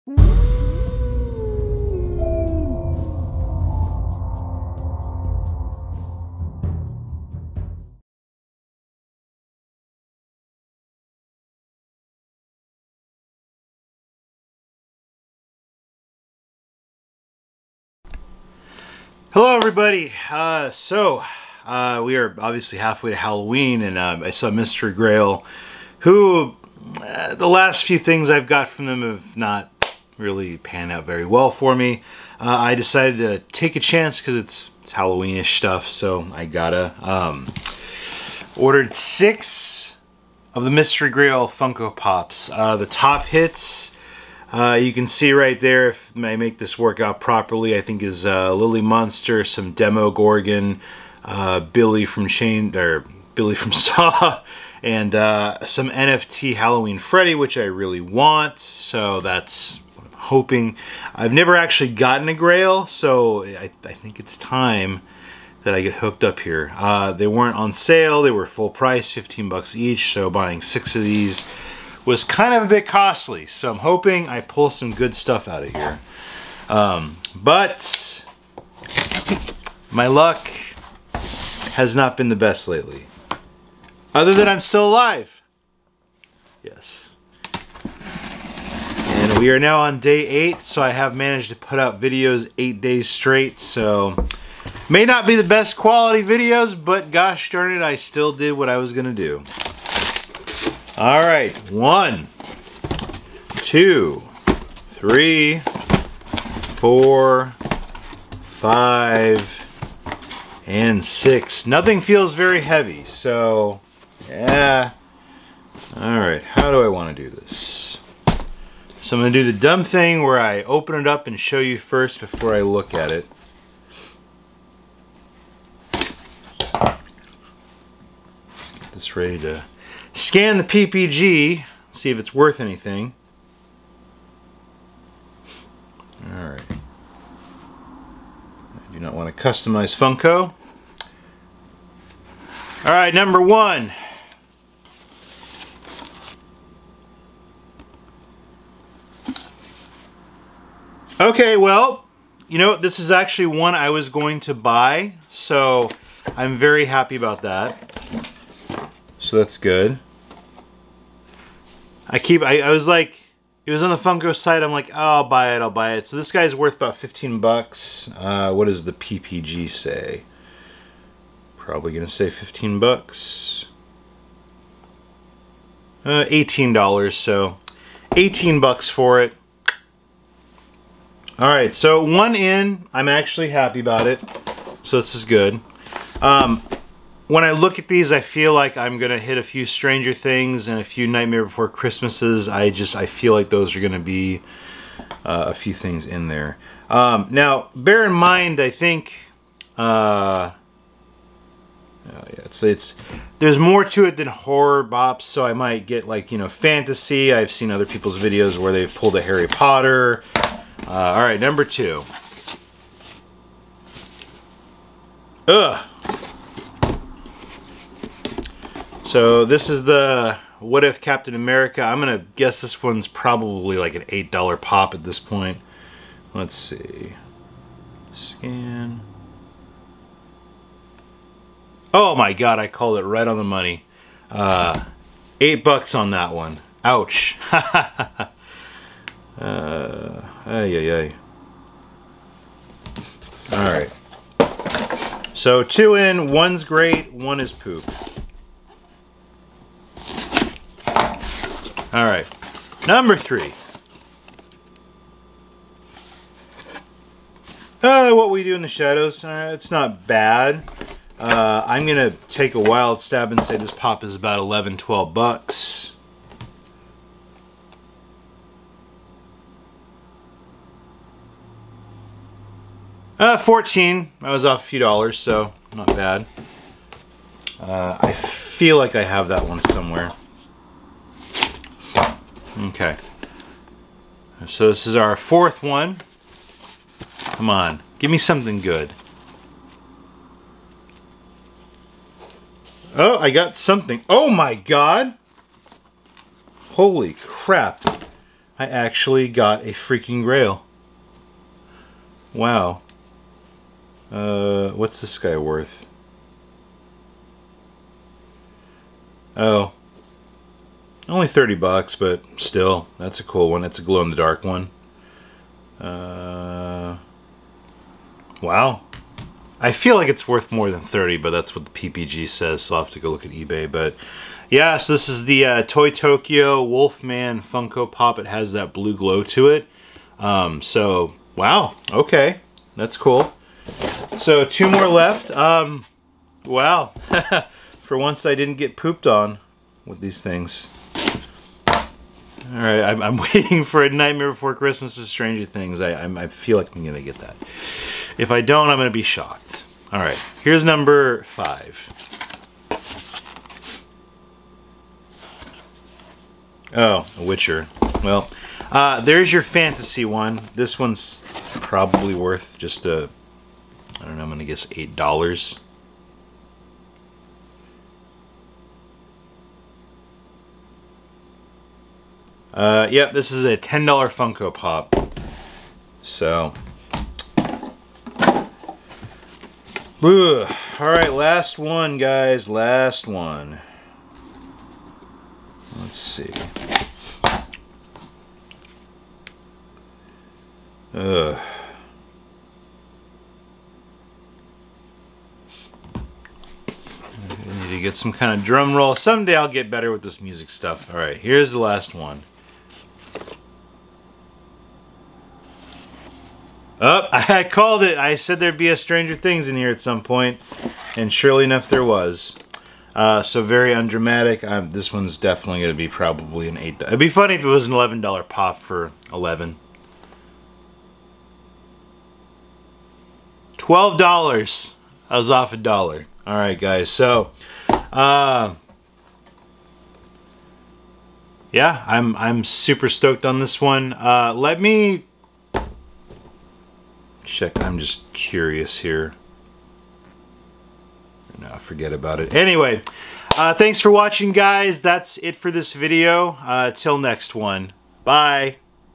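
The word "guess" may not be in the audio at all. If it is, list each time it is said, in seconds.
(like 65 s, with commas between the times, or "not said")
222 s, 364 s.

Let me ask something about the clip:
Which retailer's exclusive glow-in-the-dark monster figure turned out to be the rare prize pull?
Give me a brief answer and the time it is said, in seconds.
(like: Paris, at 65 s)
Toy Tokyo, at 325 s.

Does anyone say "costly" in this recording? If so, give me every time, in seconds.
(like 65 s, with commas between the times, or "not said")
72 s.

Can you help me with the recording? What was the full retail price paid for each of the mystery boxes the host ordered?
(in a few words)
$15.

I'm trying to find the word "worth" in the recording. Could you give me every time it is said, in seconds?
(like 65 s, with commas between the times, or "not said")
132 s, 166 s, 305 s, 320 s, 362 s.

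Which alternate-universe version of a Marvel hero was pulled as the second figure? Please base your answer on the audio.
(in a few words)
What If Captain America.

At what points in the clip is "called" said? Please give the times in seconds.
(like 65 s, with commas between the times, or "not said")
232 s, 407 s.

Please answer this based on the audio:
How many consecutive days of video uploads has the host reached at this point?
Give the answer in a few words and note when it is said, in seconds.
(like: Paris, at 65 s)
8, at 89 s.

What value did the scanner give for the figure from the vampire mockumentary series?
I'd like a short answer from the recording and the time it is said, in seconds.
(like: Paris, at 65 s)
$14, at 273 s.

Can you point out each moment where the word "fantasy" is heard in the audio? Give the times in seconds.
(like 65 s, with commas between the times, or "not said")
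206 s, 359 s.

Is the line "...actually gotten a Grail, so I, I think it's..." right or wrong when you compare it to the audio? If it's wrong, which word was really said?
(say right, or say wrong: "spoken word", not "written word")
right.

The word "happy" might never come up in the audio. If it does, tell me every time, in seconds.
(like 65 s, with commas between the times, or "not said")
156 s, 183 s.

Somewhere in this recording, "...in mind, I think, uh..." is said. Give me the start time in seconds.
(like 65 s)
198 s.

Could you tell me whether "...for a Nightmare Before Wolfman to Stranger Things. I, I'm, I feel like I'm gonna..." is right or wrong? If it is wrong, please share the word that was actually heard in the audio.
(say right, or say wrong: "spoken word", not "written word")
wrong: "Christmas", not "Wolfman".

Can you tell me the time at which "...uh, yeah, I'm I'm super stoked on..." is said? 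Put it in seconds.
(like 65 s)
427 s.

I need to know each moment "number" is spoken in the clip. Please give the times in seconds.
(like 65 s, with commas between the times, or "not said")
143 s, 211 s, 252 s, 350 s.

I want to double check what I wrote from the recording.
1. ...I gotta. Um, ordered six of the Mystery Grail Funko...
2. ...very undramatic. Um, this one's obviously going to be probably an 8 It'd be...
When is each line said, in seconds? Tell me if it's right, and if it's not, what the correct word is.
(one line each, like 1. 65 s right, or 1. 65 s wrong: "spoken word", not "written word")
1. 36 s right
2. 413 s wrong: "definitely", not "obviously".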